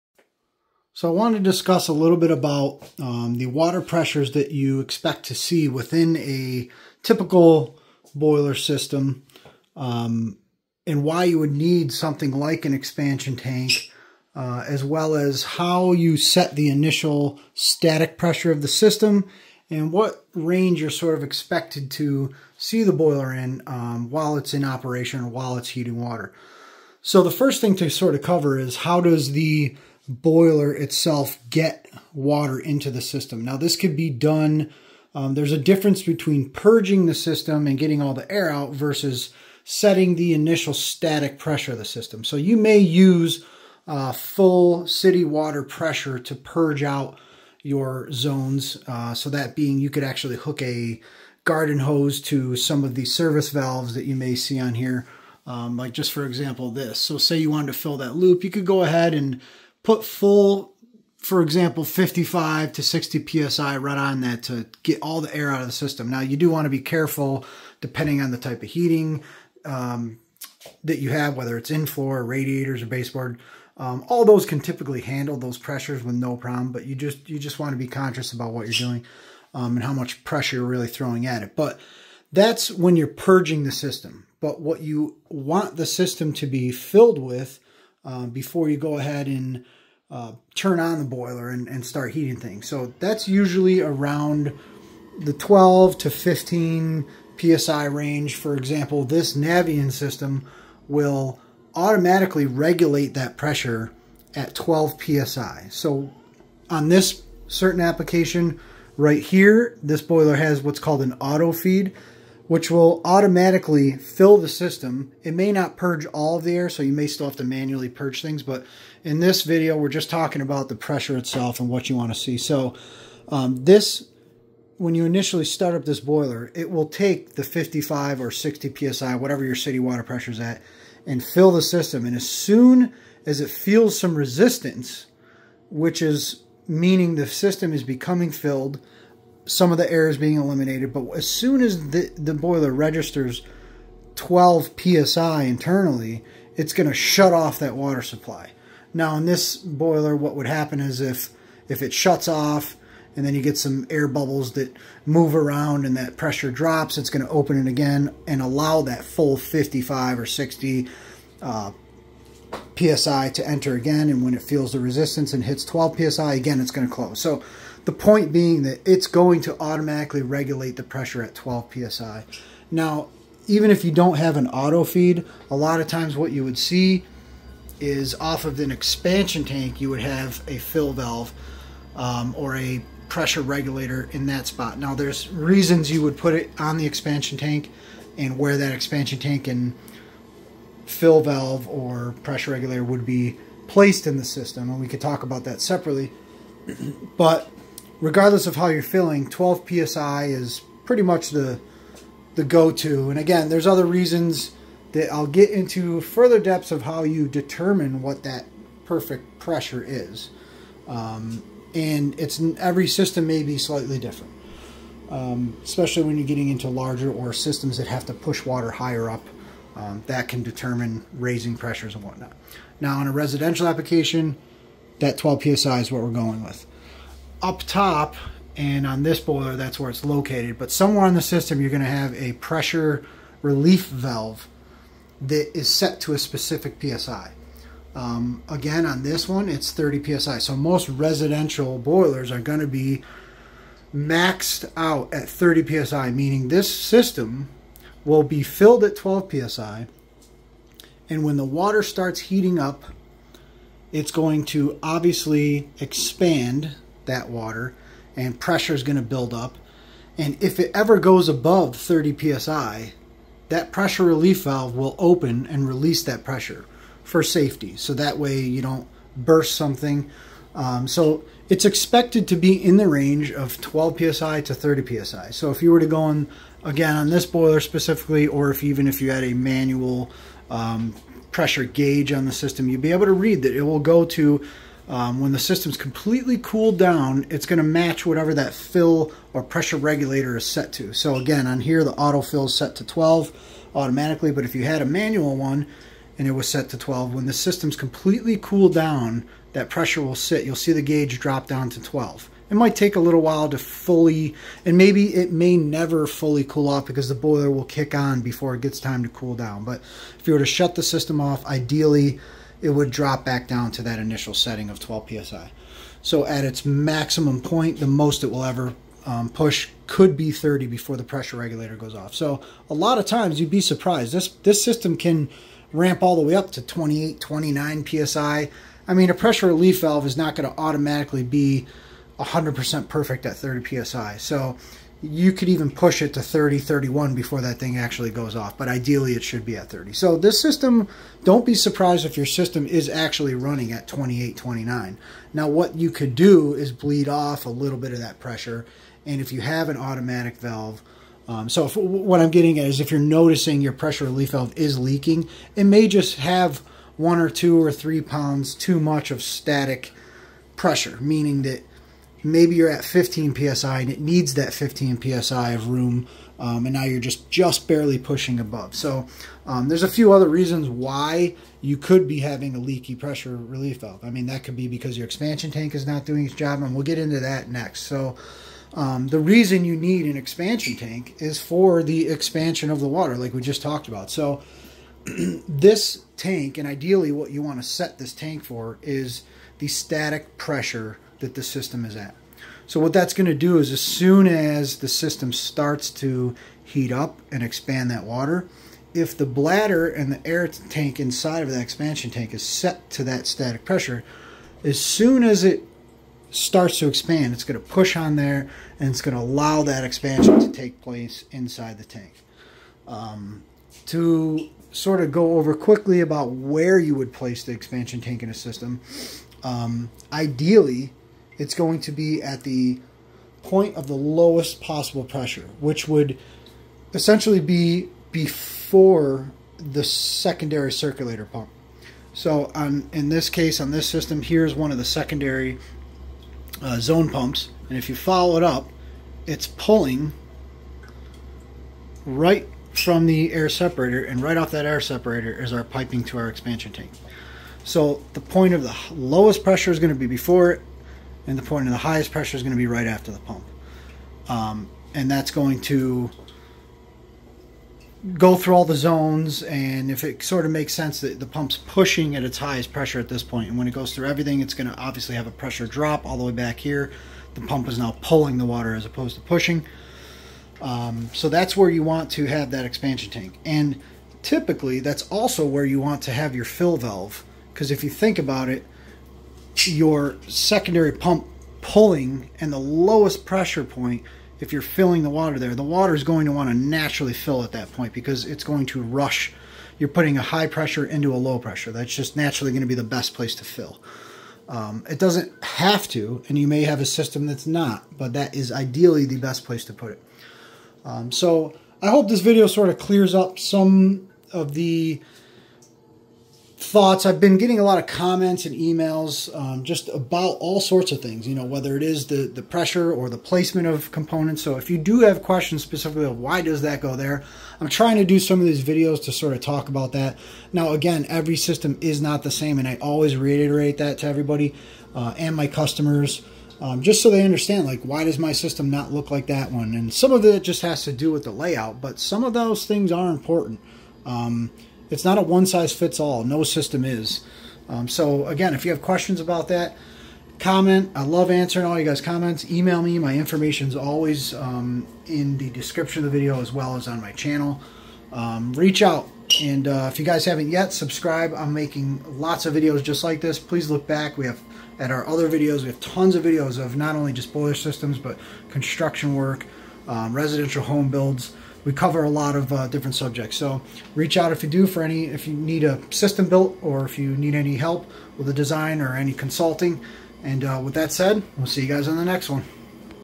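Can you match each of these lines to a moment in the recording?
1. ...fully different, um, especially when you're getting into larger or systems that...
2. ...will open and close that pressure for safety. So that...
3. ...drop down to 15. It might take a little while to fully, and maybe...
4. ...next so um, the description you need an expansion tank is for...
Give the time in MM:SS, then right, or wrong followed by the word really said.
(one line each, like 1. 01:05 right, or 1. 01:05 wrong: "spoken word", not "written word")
1. 03:33 wrong: "slightly", not "fully"
2. 04:24 wrong: "release", not "close"
3. 05:01 wrong: "12", not "15"
4. 06:17 wrong: "reason", not "description".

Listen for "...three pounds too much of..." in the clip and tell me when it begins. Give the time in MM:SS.
05:57.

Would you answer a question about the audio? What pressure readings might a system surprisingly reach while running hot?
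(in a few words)
28, 29 psi.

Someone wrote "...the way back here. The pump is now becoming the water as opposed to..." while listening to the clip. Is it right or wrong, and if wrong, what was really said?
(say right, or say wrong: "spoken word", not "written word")
wrong: "pulling", not "becoming".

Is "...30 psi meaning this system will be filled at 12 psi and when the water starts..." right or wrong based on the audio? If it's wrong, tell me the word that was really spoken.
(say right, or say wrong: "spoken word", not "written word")
right.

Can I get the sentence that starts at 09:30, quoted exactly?
And uh, with that said, we'll see you guys on the next one.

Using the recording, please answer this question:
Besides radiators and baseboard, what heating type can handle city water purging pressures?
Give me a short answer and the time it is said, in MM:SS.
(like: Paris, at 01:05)
in floor, at 01:11.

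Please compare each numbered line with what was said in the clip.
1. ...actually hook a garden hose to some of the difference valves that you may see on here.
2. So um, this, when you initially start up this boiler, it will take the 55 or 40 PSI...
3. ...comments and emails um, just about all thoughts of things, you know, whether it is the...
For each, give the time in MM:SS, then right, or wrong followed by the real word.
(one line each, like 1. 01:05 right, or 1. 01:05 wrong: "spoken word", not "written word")
1. 00:50 wrong: "service", not "difference"
2. 02:02 wrong: "60", not "40"
3. 08:27 wrong: "sorts", not "thoughts".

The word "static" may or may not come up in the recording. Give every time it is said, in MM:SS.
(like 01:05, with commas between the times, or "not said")
00:17, 00:40, 05:59, 06:29, 06:43.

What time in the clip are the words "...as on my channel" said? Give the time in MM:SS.
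09:06.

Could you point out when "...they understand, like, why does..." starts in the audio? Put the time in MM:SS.
08:47.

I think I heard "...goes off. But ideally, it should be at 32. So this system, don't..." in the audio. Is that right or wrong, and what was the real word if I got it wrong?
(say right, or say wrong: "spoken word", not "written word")
wrong: "30", not "32".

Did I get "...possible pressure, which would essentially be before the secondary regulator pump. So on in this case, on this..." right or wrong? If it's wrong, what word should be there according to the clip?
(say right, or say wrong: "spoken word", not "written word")
wrong: "circulator", not "regulator".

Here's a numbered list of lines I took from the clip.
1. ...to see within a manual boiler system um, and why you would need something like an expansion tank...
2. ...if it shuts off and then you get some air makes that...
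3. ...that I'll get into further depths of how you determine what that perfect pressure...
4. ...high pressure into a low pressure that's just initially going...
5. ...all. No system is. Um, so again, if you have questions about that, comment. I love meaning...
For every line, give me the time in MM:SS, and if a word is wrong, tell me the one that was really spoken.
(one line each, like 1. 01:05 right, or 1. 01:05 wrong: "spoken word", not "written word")
1. 00:05 wrong: "typical", not "manual"
2. 02:31 wrong: "bubbles", not "makes"
3. 03:24 right
4. 08:10 wrong: "naturally", not "initially"
5. 08:55 wrong: "answering", not "meaning".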